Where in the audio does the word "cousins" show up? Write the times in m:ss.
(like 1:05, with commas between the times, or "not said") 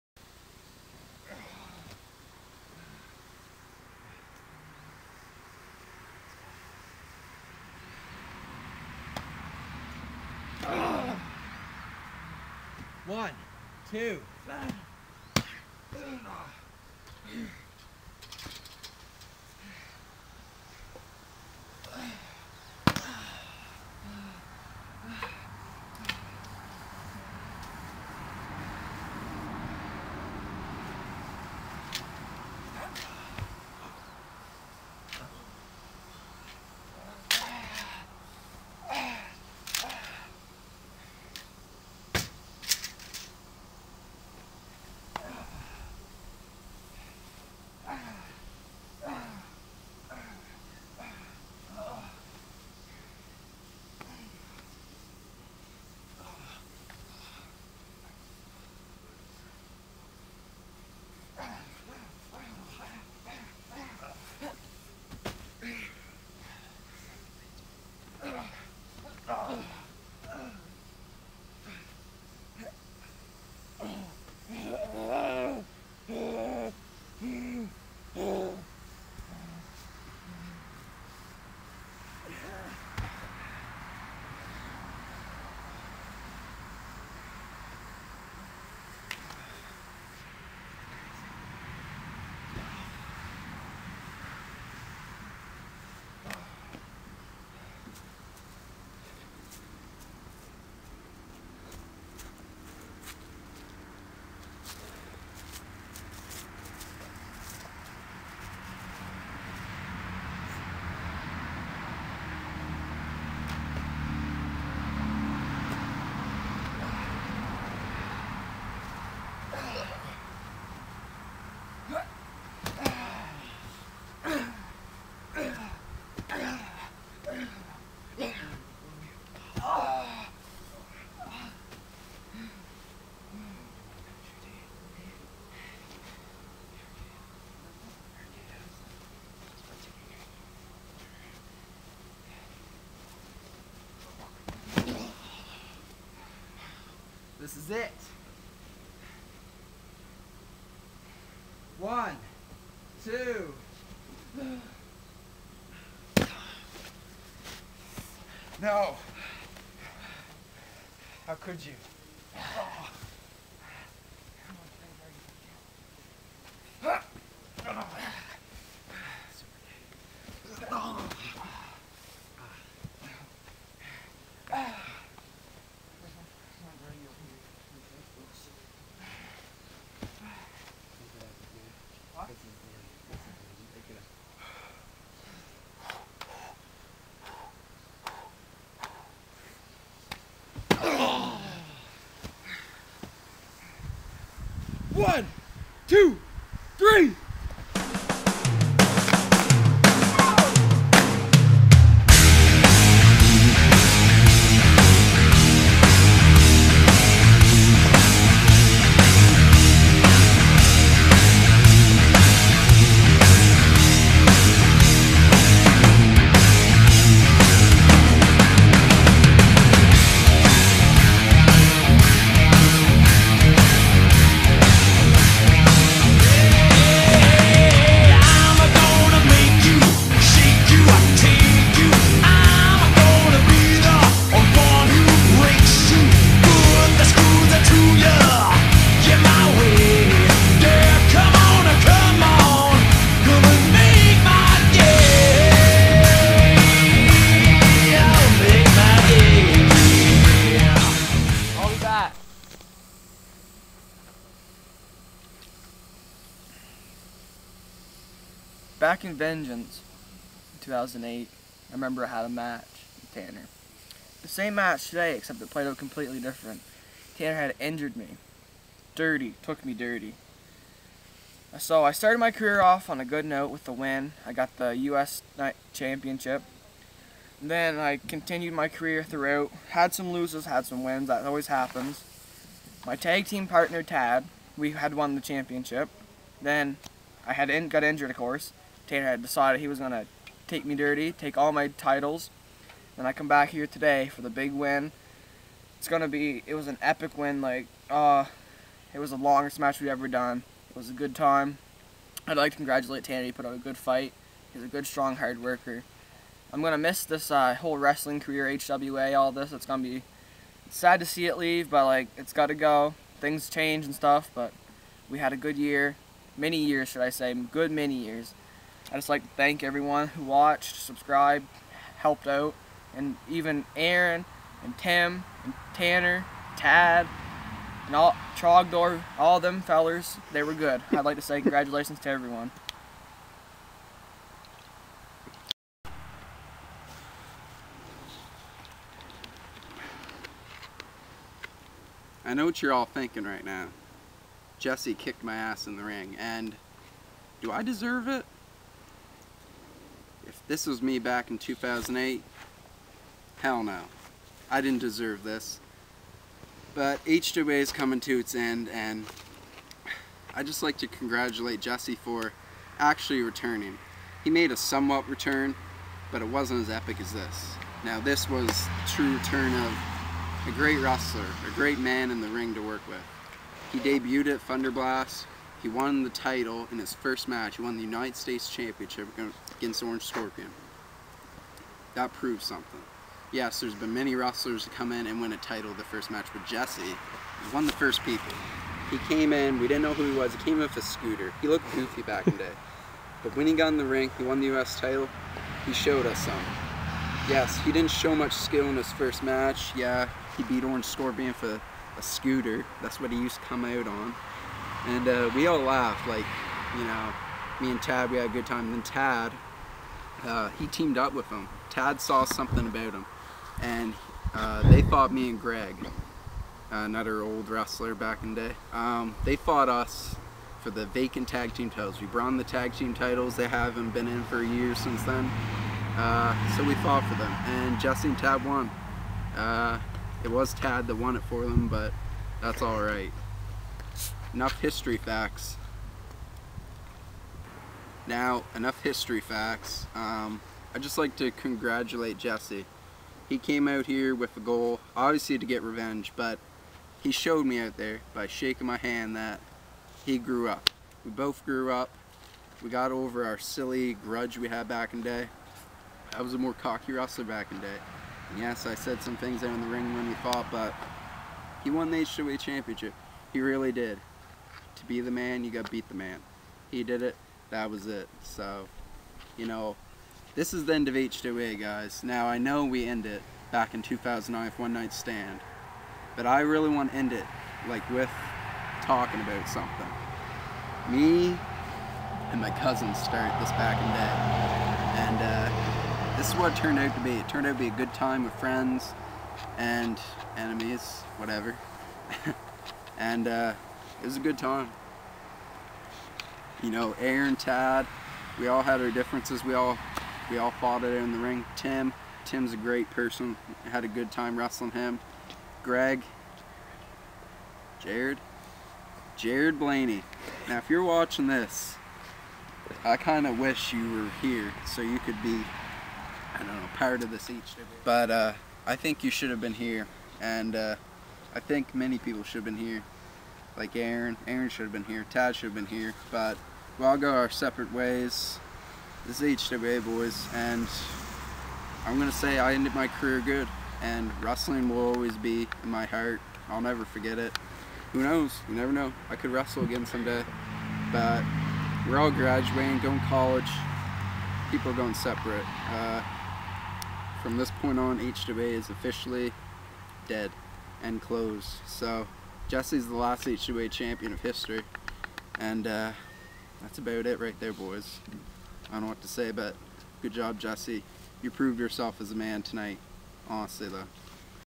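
8:02.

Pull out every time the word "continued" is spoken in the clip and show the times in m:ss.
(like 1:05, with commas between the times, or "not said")
4:38.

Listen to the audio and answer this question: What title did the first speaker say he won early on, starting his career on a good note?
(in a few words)
U.S. Championship.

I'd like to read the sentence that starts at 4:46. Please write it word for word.
Then I had in, got injured, of course.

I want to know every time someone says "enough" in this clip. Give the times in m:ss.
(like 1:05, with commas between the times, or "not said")
7:14, 7:18.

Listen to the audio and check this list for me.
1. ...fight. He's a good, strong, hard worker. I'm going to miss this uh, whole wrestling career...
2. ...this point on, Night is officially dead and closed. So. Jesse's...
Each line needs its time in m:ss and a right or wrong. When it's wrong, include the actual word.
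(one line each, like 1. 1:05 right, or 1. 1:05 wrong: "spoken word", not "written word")
1. 5:03 right
2. 9:07 wrong: "HWA", not "Night".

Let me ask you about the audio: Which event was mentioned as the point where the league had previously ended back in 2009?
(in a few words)
One Night Stand.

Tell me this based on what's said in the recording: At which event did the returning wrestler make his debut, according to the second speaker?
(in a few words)
Thunderblast.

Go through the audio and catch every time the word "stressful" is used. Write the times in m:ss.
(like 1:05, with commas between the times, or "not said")
not said.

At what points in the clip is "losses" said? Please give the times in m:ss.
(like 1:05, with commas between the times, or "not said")
4:40.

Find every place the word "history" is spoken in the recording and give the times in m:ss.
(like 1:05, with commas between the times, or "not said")
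7:14, 7:18, 9:14.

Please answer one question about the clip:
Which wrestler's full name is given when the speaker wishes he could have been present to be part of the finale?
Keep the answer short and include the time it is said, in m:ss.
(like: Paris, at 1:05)
Jared Blaney, at 8:29.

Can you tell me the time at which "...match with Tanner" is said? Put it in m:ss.
4:22.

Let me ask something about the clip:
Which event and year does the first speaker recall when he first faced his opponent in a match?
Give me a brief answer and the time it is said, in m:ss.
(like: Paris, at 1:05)
Shocking Vengeance 2008, at 4:19.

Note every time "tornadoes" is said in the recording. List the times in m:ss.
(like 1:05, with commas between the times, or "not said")
not said.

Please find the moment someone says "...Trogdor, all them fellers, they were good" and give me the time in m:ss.
5:28.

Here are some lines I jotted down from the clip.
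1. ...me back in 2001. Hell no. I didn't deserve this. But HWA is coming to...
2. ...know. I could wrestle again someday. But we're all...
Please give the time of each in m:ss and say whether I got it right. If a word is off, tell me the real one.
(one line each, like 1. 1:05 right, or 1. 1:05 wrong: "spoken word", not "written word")
1. 5:50 wrong: "2008", not "2001"
2. 8:58 right.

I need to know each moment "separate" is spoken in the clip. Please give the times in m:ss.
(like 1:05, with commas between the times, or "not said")
8:47, 9:04.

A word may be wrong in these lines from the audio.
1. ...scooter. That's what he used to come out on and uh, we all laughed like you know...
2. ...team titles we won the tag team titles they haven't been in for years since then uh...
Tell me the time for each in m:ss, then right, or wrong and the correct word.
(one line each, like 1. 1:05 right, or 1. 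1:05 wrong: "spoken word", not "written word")
1. 6:42 right
2. 7:01 right.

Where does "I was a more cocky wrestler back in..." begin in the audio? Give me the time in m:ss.
7:36.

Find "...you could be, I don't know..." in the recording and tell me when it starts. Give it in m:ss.
8:34.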